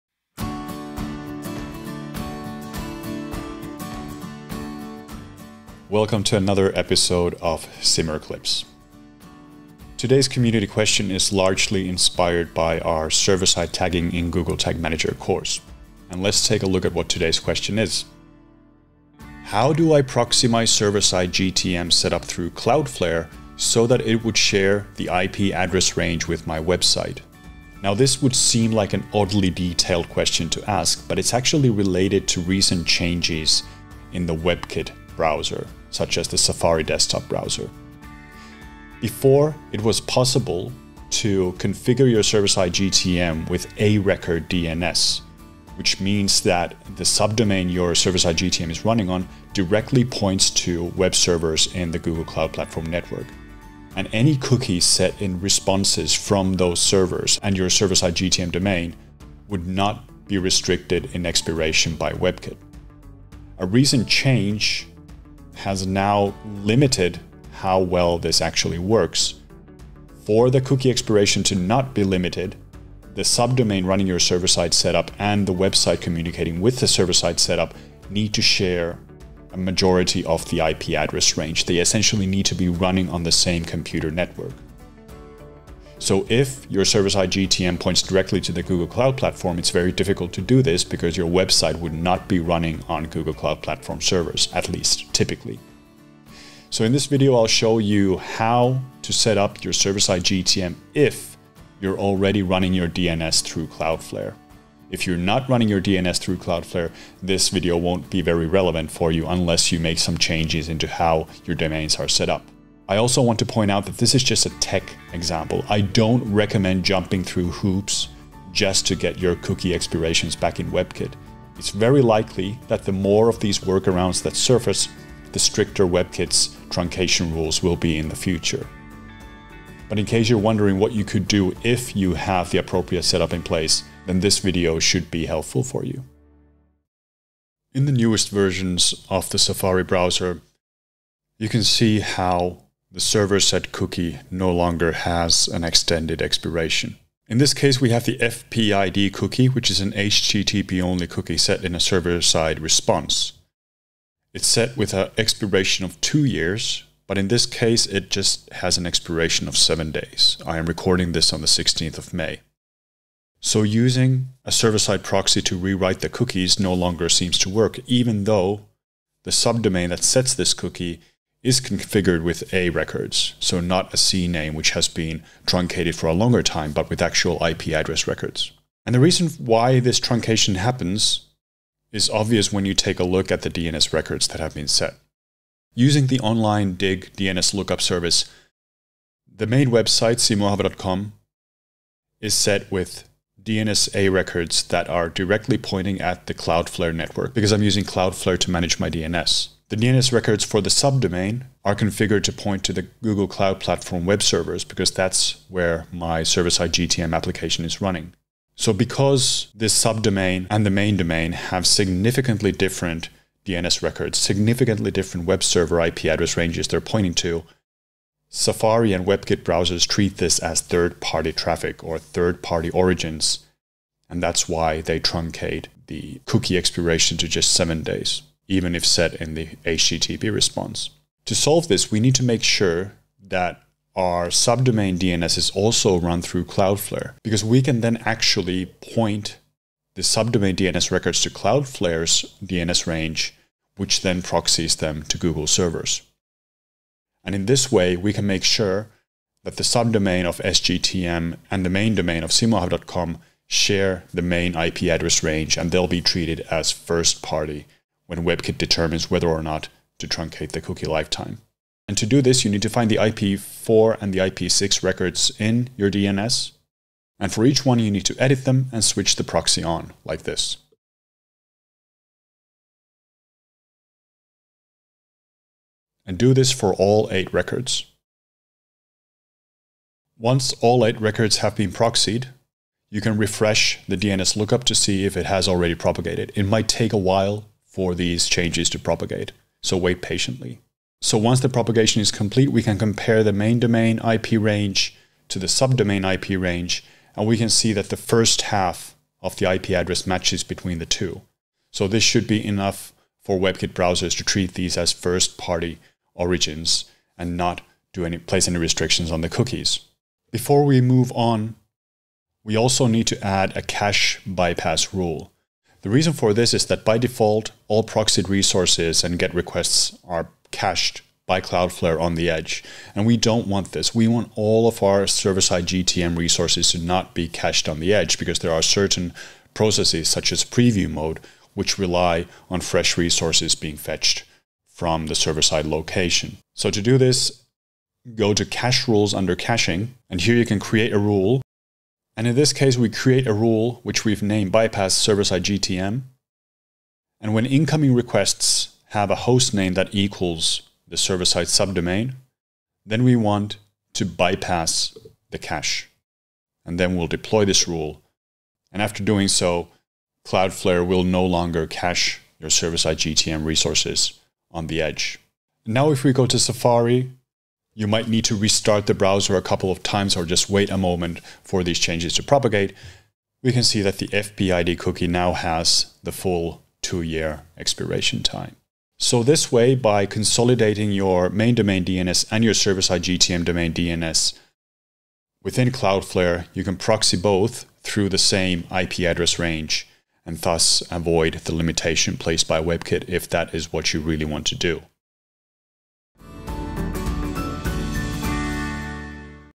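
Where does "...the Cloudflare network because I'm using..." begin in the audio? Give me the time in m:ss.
3:16.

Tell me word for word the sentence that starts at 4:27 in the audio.
And for each one, you need to edit them and switch the proxy on, like this.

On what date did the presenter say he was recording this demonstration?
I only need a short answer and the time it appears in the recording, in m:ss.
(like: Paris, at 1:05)
16 May, at 2:41.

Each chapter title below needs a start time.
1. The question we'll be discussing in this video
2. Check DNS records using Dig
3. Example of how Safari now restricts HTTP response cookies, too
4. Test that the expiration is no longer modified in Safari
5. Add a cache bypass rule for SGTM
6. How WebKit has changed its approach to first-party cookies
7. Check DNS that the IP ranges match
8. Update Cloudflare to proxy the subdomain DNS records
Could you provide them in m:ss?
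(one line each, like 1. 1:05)
1. 0:18
2. 3:05
3. 2:16
4. 6:05
5. 5:09
6. 0:38
7. 4:50
8. 3:50.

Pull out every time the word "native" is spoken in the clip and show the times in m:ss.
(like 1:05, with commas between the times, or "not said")
not said.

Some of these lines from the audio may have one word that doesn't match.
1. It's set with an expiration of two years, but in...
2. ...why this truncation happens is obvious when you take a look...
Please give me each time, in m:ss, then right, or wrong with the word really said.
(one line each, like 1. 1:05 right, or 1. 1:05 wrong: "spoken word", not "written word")
1. 2:34 right
2. 2:59 right.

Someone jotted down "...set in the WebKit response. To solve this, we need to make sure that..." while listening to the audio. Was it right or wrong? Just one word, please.
wrong.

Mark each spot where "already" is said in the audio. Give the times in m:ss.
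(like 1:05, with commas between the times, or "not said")
1:41, 4:45.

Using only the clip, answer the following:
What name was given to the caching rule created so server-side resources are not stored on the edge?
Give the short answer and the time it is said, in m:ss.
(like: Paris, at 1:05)
bypass server-side GTM, at 5:44.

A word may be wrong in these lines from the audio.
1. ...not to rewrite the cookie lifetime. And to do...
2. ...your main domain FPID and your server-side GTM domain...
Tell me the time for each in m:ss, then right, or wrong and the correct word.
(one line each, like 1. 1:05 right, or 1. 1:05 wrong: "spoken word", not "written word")
1. 4:19 wrong: "truncate", not "rewrite"
2. 6:20 wrong: "DNS", not "FPID".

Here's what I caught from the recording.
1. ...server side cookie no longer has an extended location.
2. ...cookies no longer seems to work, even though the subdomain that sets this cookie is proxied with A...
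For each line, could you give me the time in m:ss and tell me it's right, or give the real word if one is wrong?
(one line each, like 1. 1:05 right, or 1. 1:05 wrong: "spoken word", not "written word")
1. 2:22 wrong: "expiration", not "location"
2. 2:46 wrong: "configured", not "proxied".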